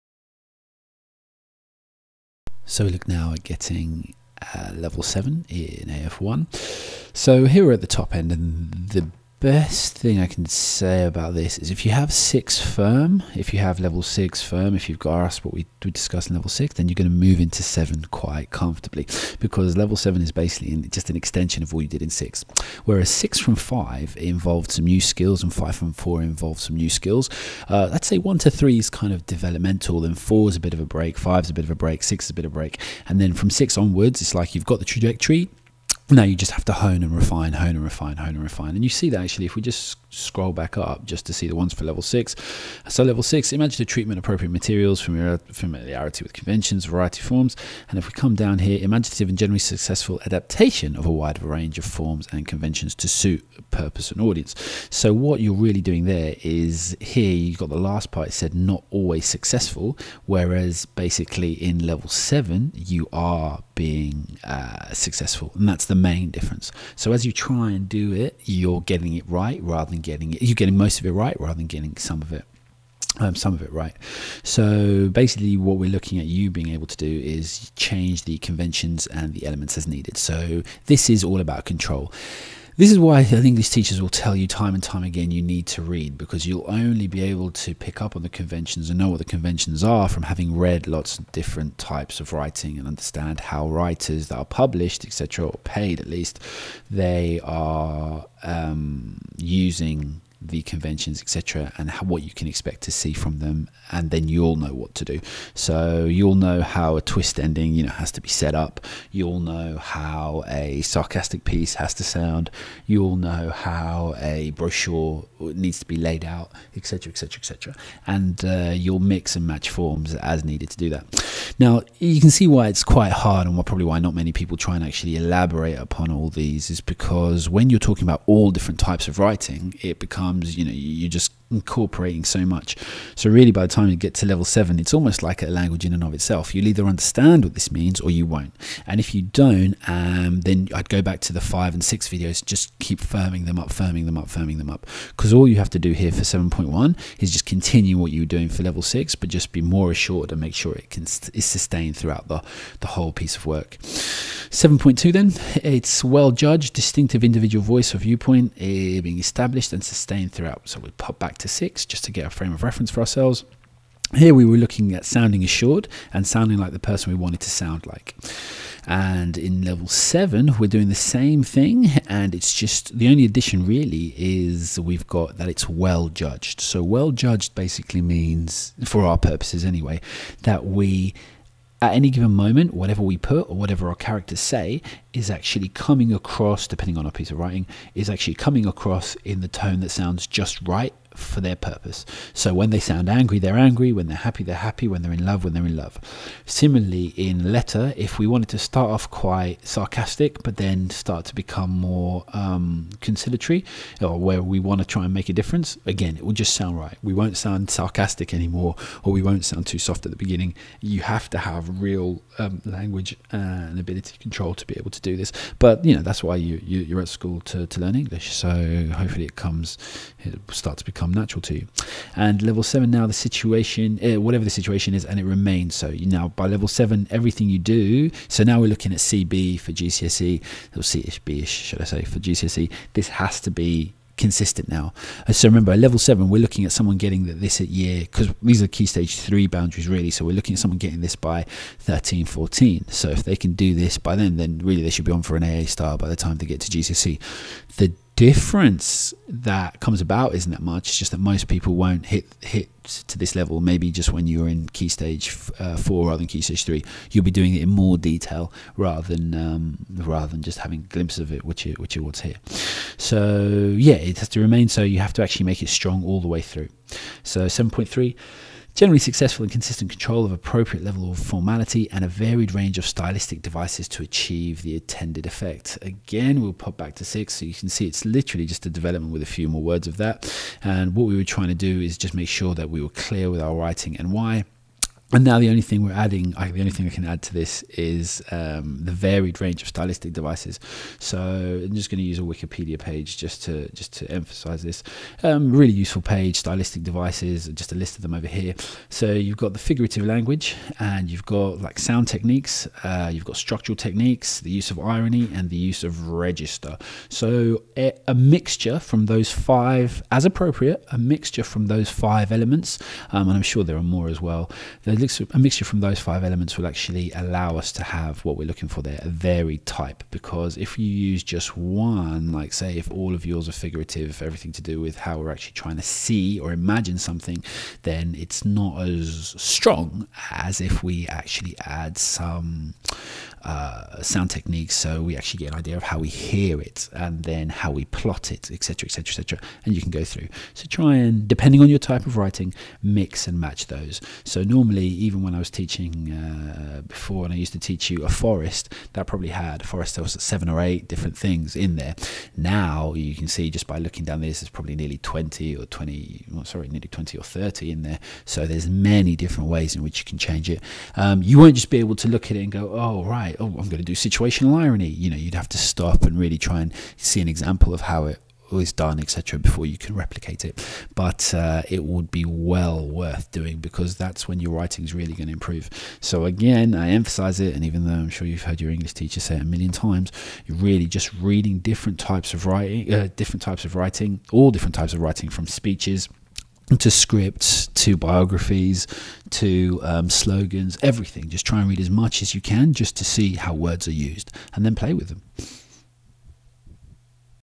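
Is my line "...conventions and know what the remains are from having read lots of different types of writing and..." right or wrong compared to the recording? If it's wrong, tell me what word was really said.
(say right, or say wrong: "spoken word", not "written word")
wrong: "conventions", not "remains".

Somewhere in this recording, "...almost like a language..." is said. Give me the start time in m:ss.
2:14.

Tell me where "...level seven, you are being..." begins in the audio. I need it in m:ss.
1:01.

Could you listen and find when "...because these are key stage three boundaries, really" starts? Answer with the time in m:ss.
3:58.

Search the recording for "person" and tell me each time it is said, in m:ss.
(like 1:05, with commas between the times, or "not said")
2:46.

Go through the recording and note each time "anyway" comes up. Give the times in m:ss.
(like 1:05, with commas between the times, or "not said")
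2:59.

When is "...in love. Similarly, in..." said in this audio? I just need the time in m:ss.
3:15.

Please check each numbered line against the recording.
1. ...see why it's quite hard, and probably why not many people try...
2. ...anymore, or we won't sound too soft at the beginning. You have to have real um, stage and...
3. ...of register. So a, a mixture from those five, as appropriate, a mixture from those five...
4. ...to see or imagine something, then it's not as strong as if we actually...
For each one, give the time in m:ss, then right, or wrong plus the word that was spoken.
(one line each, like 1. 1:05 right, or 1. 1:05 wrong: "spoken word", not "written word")
1. 2:02 right
2. 3:28 wrong: "language", not "stage"
3. 5:05 right
4. 5:25 right.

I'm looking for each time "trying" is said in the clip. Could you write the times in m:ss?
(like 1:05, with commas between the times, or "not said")
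4:41, 5:25.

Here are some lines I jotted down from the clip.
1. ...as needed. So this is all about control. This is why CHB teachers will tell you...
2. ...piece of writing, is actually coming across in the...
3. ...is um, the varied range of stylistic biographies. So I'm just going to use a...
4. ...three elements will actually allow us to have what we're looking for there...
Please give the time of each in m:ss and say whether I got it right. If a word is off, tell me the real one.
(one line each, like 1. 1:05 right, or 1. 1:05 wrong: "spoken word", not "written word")
1. 1:19 wrong: "English", not "CHB"
2. 3:07 right
3. 4:47 wrong: "devices", not "biographies"
4. 5:15 wrong: "five", not "three".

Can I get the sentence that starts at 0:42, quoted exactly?
So level six, imagine the treatment appropriate materials, familiarity with conventions, variety forms.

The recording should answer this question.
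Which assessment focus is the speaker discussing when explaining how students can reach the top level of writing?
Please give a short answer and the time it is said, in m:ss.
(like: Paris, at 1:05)
AF1, at 0:05.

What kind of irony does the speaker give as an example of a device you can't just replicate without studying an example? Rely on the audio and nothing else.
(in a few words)
situational irony.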